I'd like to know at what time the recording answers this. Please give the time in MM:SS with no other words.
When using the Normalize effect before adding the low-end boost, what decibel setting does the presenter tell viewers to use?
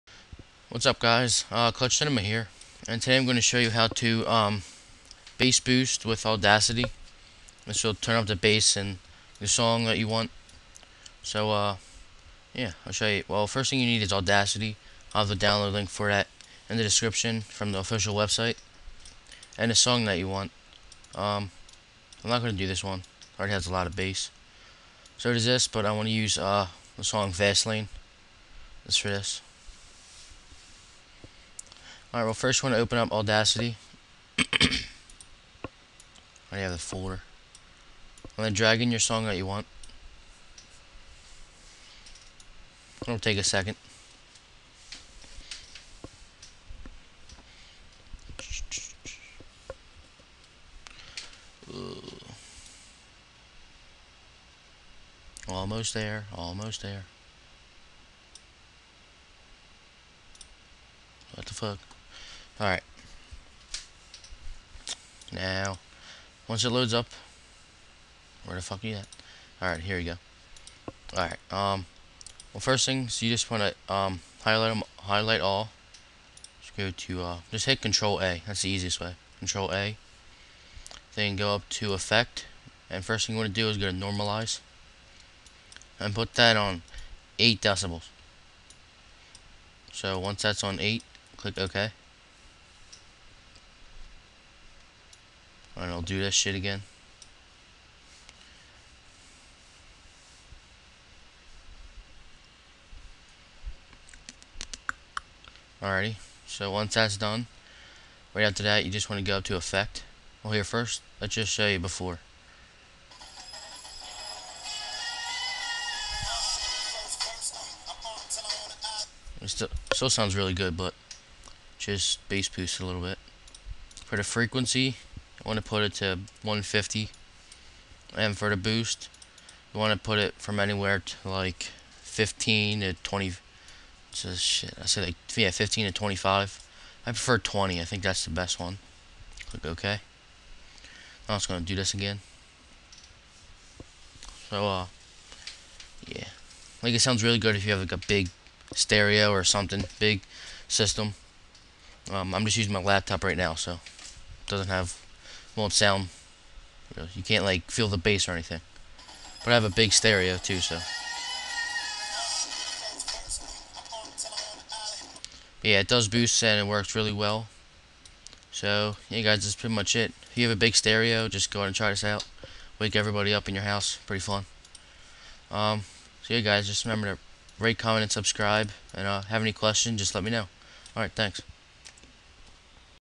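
01:27.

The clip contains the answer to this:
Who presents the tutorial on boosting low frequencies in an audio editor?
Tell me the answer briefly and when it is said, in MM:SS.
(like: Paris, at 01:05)
Klutch Cinema, at 00:01.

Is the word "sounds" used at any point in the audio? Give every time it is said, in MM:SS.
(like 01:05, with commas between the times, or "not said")
02:00, 02:26, 02:35.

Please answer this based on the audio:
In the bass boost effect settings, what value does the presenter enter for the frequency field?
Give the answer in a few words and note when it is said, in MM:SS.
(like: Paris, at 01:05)
150, at 02:06.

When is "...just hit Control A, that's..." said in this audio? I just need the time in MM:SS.
01:17.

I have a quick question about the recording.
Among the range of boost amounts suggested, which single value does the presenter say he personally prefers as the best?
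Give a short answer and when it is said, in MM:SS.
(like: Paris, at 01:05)
20, at 02:17.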